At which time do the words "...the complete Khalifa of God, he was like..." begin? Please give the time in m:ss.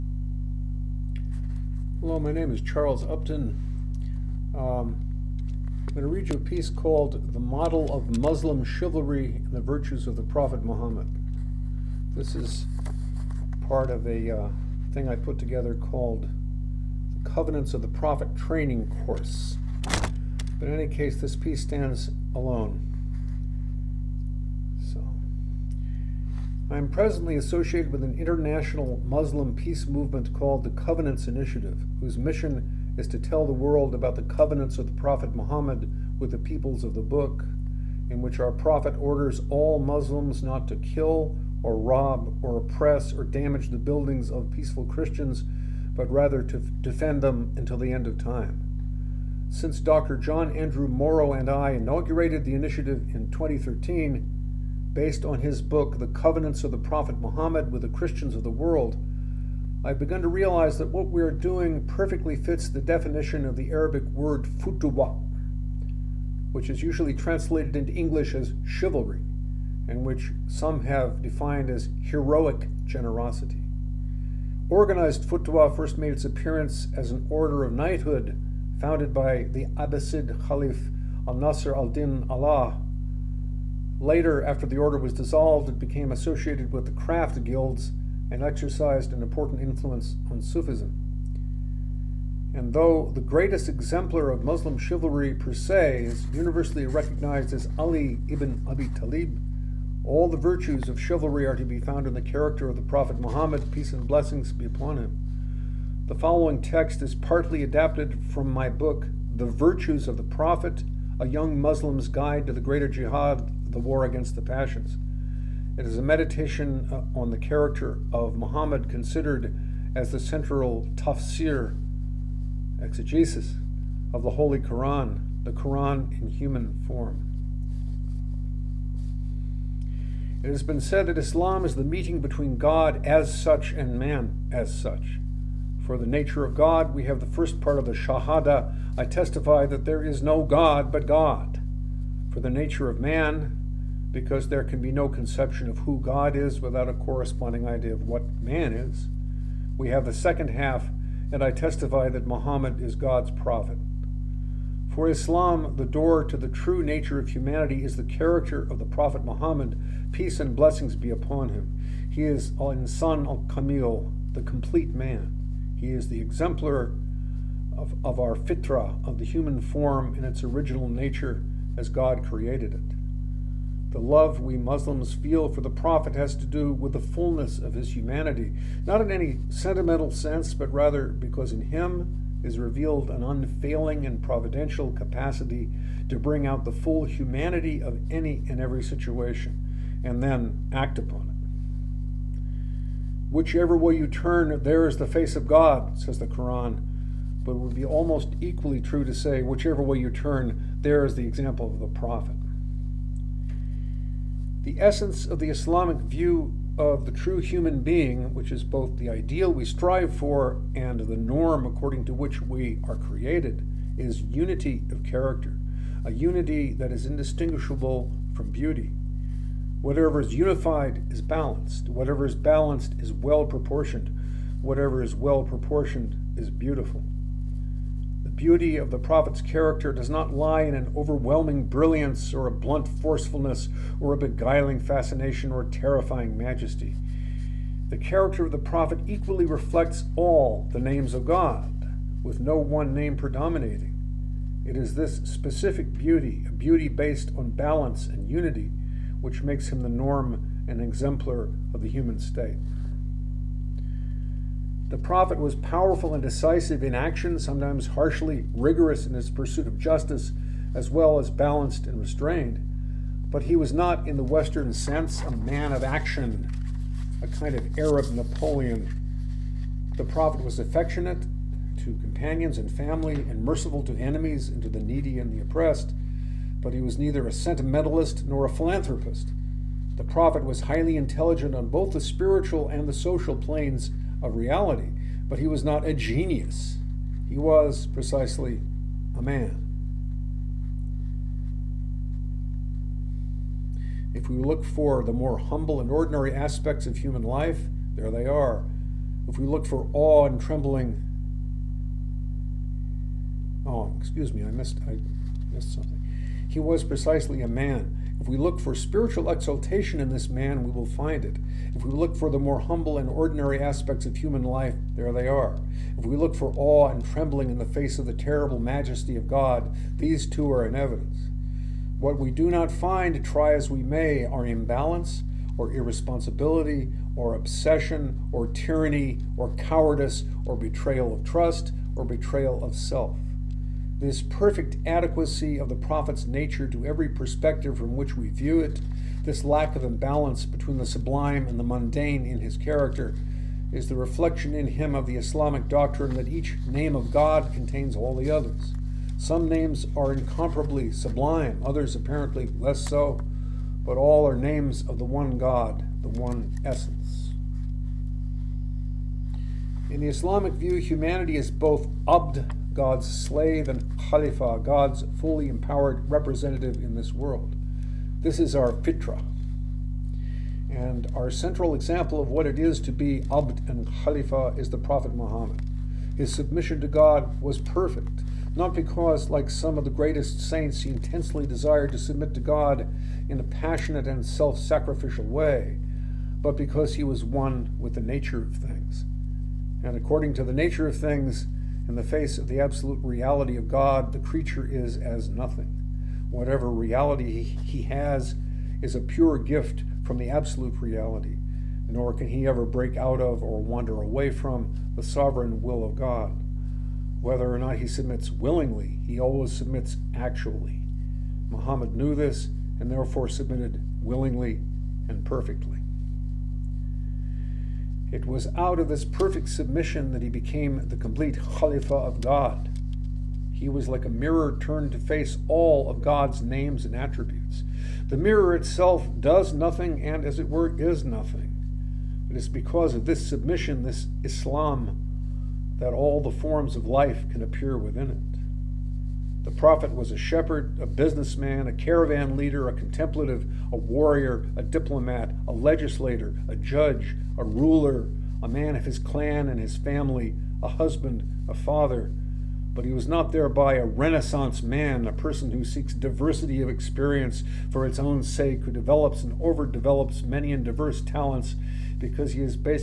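7:00.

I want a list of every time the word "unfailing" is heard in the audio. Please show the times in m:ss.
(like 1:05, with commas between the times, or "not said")
3:03.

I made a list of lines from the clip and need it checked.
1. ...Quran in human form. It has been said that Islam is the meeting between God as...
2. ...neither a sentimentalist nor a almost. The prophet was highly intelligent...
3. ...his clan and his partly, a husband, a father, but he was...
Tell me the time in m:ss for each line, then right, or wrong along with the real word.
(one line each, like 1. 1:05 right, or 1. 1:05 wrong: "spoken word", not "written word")
1. 2:05 right
2. 4:36 wrong: "philanthropist", not "almost"
3. 7:28 wrong: "family", not "partly".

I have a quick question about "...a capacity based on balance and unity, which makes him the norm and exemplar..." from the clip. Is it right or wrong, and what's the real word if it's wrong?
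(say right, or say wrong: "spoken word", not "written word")
wrong: "beauty", not "capacity".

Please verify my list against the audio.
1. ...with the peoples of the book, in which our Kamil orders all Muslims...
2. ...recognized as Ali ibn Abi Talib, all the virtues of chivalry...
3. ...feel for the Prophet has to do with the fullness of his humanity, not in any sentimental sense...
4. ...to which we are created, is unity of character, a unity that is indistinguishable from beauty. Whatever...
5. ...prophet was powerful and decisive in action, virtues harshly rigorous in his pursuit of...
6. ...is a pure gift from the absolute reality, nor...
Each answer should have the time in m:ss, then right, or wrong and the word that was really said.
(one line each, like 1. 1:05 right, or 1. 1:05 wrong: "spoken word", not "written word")
1. 0:36 wrong: "Prophet", not "Kamil"
2. 1:36 right
3. 2:55 right
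4. 3:32 right
5. 4:14 wrong: "sometimes", not "virtues"
6. 6:38 right.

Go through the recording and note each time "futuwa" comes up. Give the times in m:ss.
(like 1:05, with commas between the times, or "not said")
1:04, 1:15.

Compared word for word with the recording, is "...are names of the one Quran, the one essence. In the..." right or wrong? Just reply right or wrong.
wrong.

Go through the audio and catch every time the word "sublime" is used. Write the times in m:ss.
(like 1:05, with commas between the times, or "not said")
5:40, 5:50.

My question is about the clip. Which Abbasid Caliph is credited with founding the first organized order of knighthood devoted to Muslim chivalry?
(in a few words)
al Nasr al Din Allah.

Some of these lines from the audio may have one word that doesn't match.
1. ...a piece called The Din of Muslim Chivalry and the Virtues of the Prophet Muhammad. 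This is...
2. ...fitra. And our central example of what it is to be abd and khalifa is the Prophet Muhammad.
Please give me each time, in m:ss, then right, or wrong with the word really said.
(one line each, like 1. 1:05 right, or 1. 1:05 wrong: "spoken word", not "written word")
1. 0:06 wrong: "Model", not "Din"
2. 6:08 right.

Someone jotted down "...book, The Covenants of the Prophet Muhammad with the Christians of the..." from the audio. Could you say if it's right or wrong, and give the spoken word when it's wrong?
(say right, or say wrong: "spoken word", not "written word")
right.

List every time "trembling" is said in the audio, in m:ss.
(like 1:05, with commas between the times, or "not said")
5:00, 5:17.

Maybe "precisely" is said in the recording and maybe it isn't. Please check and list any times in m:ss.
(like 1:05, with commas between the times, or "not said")
4:47, 5:06.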